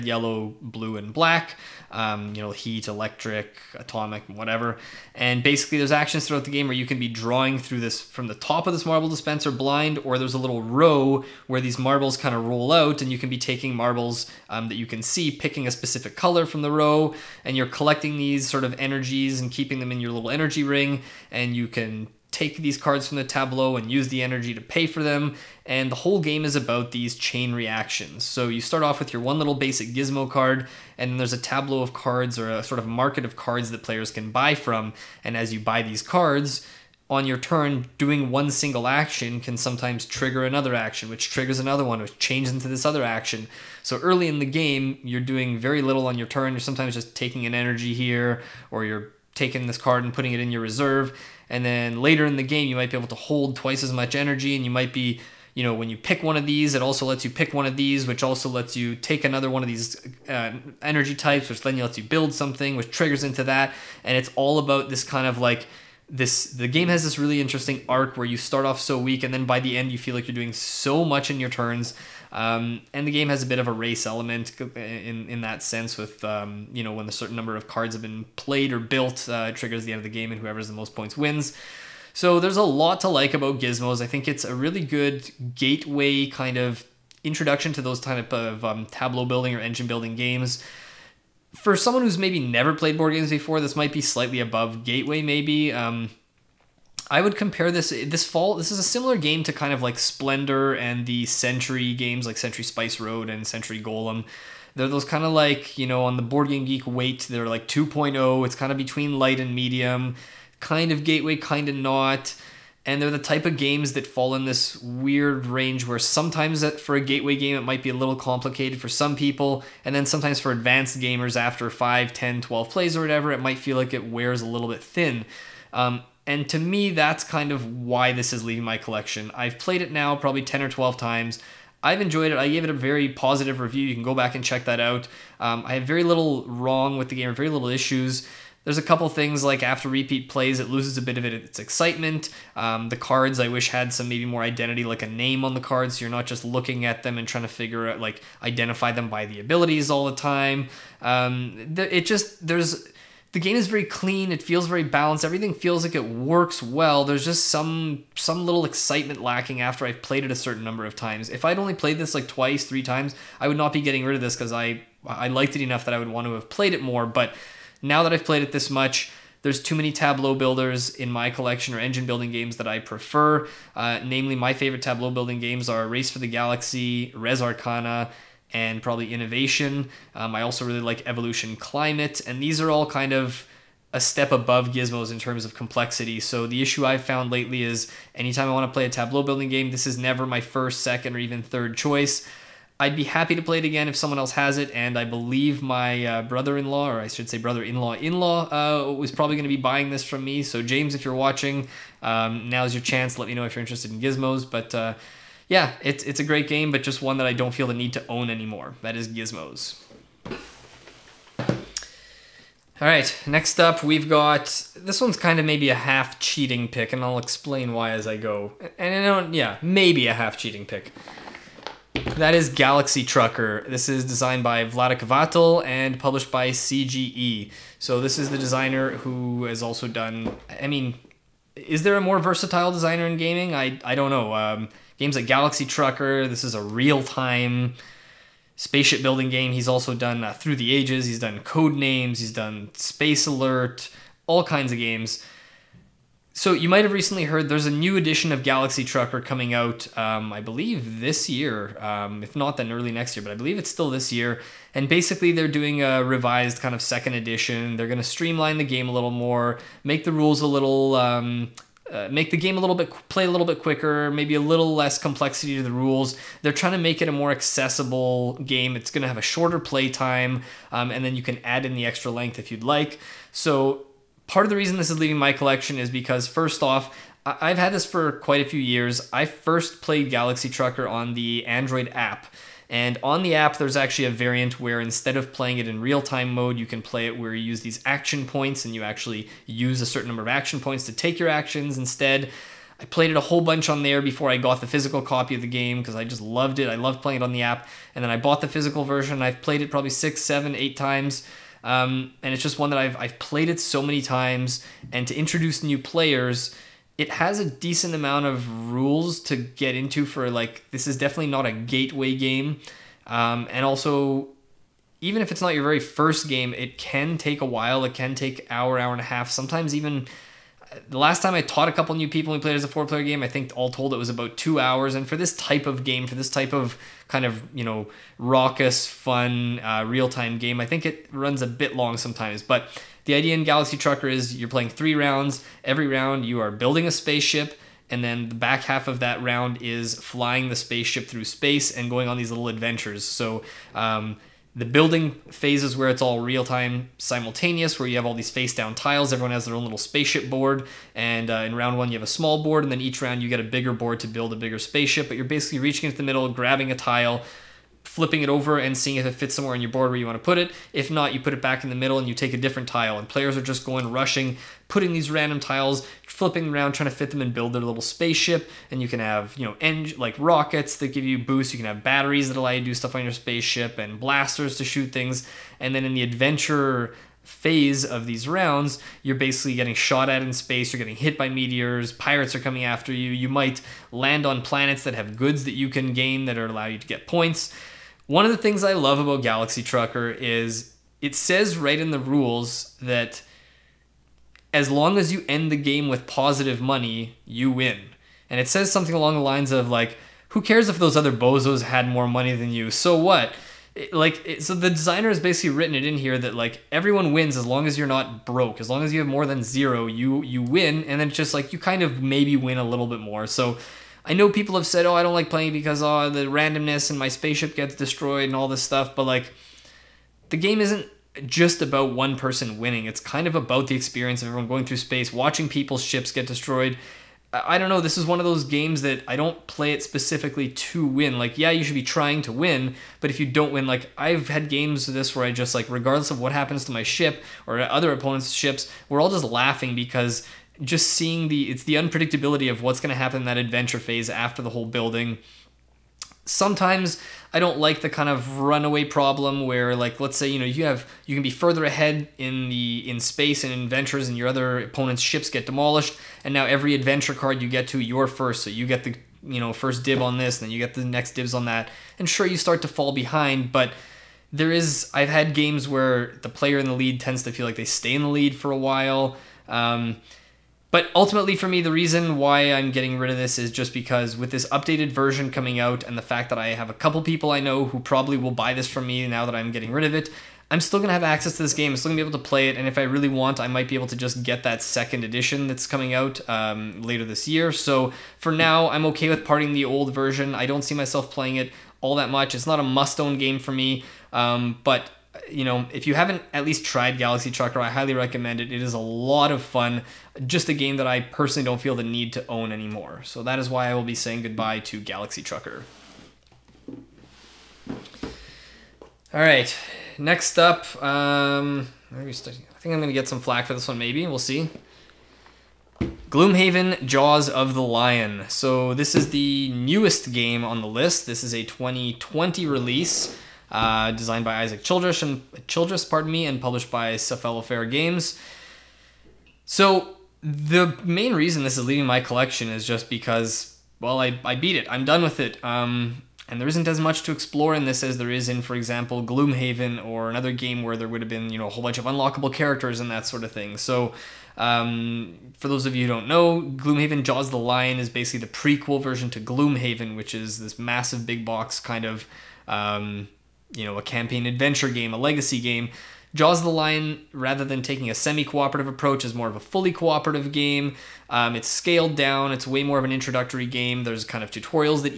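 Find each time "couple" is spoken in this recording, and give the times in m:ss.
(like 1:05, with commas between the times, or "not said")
2:18, 5:21, 7:56.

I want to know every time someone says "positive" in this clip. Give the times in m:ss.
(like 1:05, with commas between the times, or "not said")
2:13, 6:36.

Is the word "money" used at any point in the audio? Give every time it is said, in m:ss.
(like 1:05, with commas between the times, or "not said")
6:36, 6:42.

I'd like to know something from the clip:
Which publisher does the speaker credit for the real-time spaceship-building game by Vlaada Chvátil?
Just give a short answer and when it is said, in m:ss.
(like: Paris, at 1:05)
CGE, at 3:46.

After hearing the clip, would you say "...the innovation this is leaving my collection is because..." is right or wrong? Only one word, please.
wrong.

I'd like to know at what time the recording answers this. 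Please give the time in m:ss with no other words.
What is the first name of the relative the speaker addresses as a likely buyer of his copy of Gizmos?
3:20.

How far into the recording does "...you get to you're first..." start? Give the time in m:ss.
7:37.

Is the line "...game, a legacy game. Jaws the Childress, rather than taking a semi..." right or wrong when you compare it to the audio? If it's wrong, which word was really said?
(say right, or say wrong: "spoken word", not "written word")
wrong: "Lion", not "Childress".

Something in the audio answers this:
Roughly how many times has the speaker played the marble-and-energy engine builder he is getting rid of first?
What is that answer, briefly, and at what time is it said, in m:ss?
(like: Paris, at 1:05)
10 or 12, at 2:10.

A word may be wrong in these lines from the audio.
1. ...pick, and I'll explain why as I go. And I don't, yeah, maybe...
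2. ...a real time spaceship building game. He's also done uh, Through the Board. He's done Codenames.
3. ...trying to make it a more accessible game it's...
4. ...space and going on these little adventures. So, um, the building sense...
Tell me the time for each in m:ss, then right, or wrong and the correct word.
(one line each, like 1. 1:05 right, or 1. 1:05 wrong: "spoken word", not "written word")
1. 3:36 right
2. 3:56 wrong: "Ages", not "Board"
3. 4:26 right
4. 5:41 wrong: "phase", not "sense".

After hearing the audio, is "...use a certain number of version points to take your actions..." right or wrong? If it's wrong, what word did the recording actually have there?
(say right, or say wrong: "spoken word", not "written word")
wrong: "action", not "version".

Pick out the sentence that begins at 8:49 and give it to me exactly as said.
So the main reason this is leaving my collection is just because, well, I, I beat it.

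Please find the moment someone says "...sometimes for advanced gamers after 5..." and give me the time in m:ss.
2:00.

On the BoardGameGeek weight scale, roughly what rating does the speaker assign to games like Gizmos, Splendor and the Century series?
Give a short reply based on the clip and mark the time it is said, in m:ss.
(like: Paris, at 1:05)
2.0, at 1:47.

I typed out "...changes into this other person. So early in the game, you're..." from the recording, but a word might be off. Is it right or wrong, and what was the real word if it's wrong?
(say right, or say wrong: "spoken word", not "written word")
wrong: "action", not "person".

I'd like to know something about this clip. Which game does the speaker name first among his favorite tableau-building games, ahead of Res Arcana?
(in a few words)
Race for the Galaxy.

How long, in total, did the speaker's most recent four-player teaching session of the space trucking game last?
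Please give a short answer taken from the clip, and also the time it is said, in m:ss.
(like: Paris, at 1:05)
About two hours, at 5:24.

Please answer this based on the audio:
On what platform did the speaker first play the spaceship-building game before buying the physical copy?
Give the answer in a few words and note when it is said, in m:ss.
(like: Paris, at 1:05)
Android app, at 4:41.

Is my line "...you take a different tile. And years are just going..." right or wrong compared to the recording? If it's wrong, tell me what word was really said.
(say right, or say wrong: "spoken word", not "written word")
wrong: "players", not "years".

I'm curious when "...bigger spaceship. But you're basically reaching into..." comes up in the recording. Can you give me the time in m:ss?
5:54.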